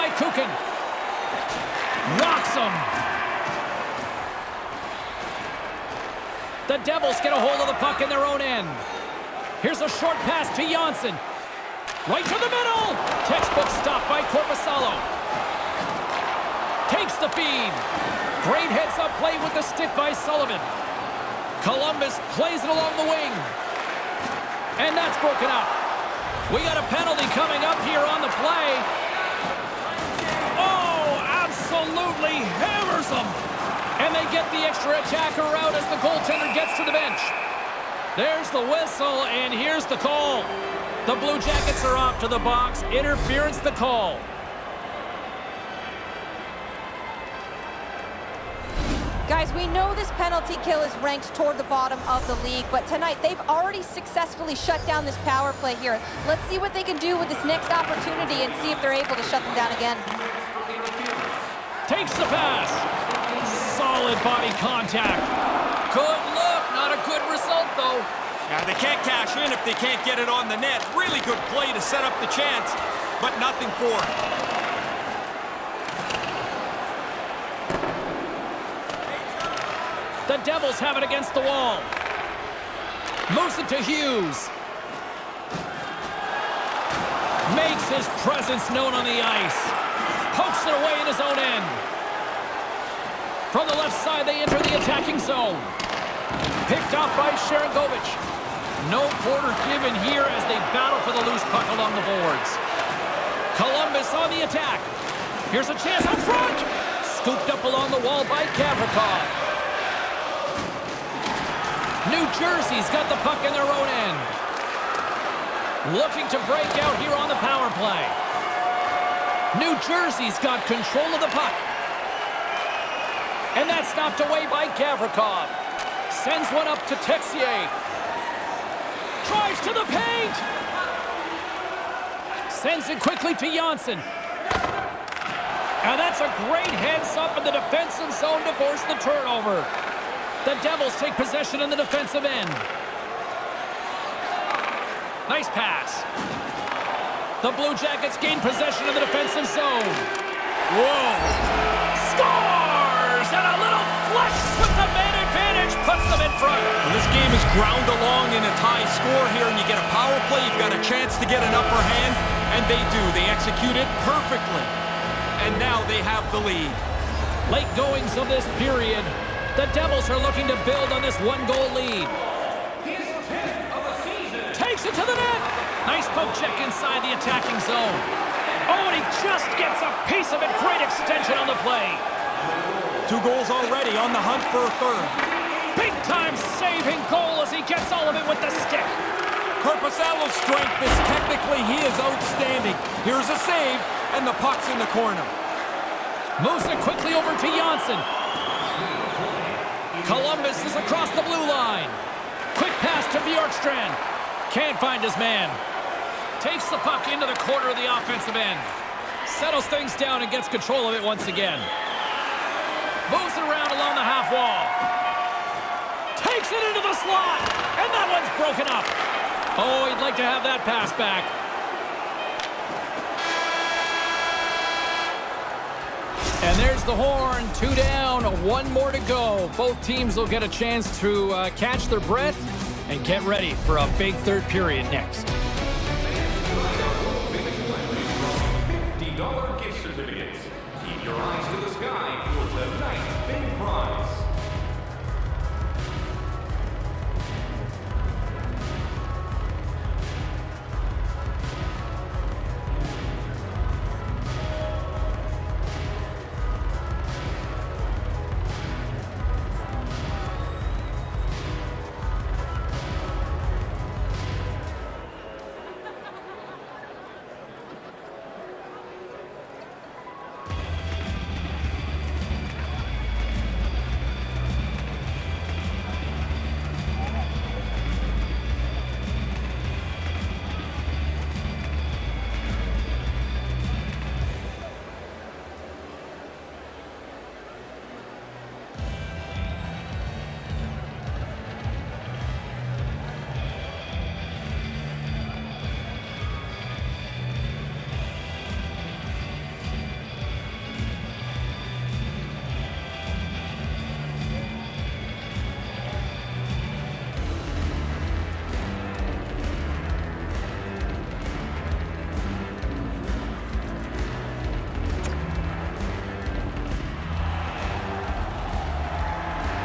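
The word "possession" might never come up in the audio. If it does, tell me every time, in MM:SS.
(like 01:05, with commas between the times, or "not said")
02:21, 02:28.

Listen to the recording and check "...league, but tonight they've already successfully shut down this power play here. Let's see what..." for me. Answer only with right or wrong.
right.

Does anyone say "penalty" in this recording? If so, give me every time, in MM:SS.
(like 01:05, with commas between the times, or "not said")
00:26, 00:50.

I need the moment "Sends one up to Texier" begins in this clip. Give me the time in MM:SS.
02:06.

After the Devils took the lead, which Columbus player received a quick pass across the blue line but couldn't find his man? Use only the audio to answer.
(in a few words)
Bjorkstrand.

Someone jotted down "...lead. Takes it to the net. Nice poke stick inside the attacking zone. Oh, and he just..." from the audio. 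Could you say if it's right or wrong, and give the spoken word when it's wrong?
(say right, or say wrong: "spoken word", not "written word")
wrong: "check", not "stick".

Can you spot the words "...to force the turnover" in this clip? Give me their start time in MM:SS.
02:18.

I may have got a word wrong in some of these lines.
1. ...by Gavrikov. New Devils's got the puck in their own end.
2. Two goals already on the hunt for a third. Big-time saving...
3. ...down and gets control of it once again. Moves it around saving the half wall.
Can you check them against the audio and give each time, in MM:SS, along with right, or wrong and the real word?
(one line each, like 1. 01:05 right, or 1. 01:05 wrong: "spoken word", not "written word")
1. 01:48 wrong: "Jersey", not "Devils"
2. 03:03 right
3. 03:29 wrong: "along", not "saving".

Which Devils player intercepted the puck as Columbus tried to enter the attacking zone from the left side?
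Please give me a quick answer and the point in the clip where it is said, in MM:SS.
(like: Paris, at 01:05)
Sharangovich, at 01:37.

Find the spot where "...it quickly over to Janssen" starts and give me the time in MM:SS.
03:16.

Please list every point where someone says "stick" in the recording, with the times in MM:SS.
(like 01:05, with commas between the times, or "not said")
00:19, 03:08.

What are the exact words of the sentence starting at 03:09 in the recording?
Korpisalo's strength is technically he is outstanding.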